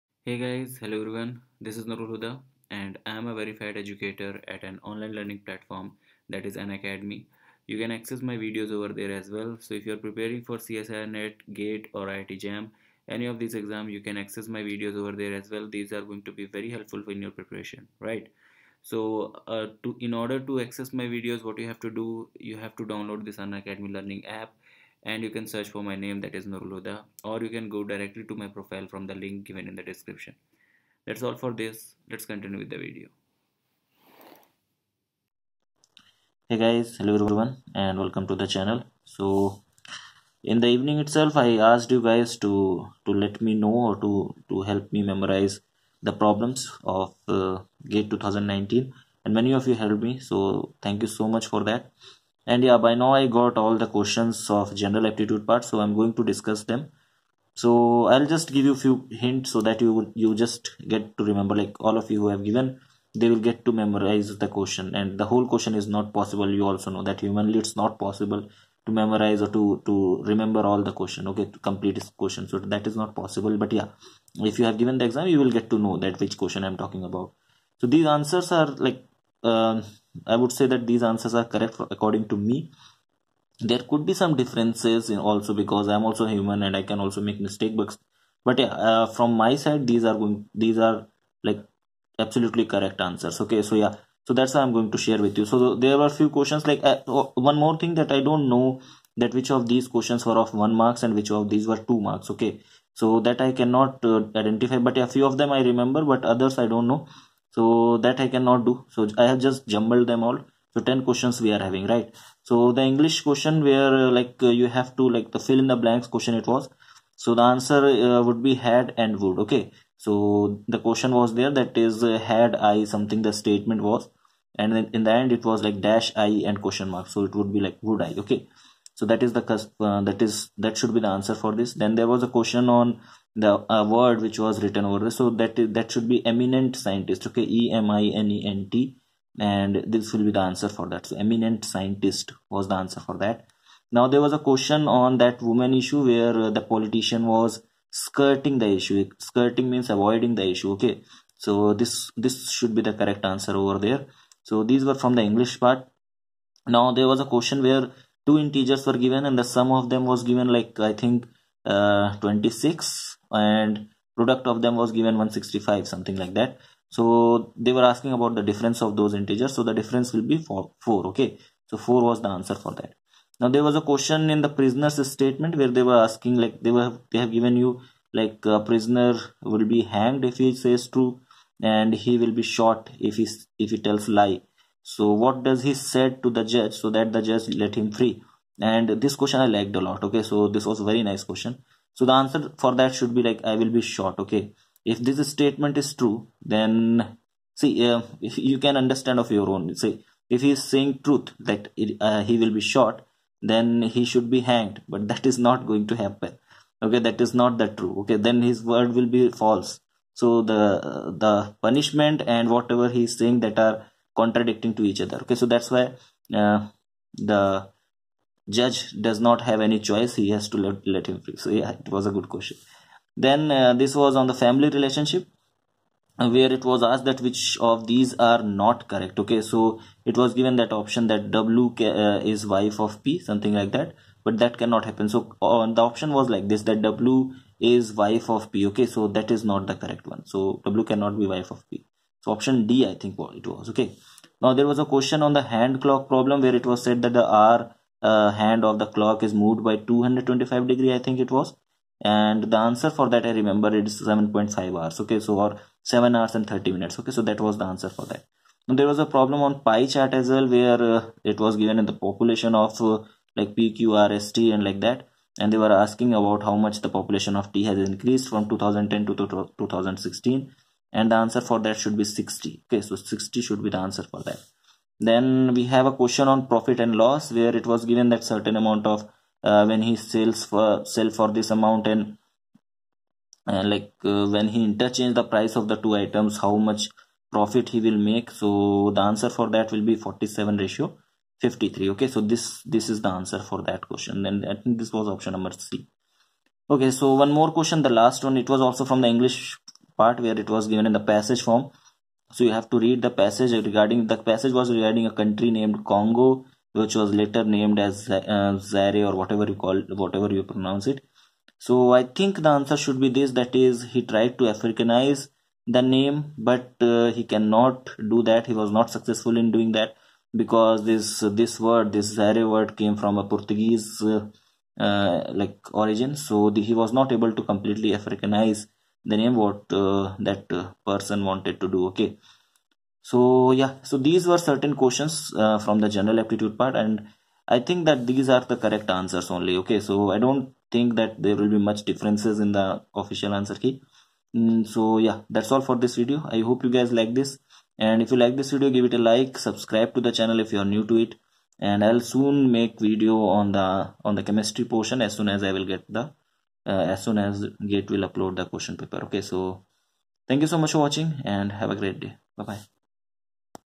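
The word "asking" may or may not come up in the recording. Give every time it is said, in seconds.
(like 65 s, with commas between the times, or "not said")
167 s, 176 s, 265 s.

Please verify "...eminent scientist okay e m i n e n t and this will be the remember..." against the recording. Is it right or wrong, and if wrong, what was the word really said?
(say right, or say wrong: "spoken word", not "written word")
wrong: "answer", not "remember".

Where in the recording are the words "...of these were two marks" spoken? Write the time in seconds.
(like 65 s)
101 s.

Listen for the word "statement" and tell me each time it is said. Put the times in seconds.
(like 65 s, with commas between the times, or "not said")
123 s, 175 s, 195 s.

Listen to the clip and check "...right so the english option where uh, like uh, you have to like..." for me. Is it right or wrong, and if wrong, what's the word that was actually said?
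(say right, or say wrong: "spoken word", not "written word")
wrong: "question", not "option".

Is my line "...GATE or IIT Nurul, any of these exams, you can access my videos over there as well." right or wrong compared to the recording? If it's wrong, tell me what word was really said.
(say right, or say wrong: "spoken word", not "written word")
wrong: "JAM", not "Nurul".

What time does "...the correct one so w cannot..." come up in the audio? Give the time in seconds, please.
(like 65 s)
239 s.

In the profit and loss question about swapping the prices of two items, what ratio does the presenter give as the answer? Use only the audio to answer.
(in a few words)
47:53.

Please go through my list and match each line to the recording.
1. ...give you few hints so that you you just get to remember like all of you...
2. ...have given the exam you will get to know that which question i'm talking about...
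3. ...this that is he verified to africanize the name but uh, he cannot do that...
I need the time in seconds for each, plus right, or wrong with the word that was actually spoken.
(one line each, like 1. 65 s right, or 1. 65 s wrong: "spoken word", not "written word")
1. 58 s right
2. 74 s right
3. 313 s wrong: "tried", not "verified".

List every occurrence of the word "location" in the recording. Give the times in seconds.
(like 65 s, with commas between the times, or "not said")
not said.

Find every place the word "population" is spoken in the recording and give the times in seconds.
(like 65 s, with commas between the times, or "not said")
261 s, 266 s.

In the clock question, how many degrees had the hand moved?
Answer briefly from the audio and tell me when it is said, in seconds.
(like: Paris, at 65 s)
225 degrees, at 249 s.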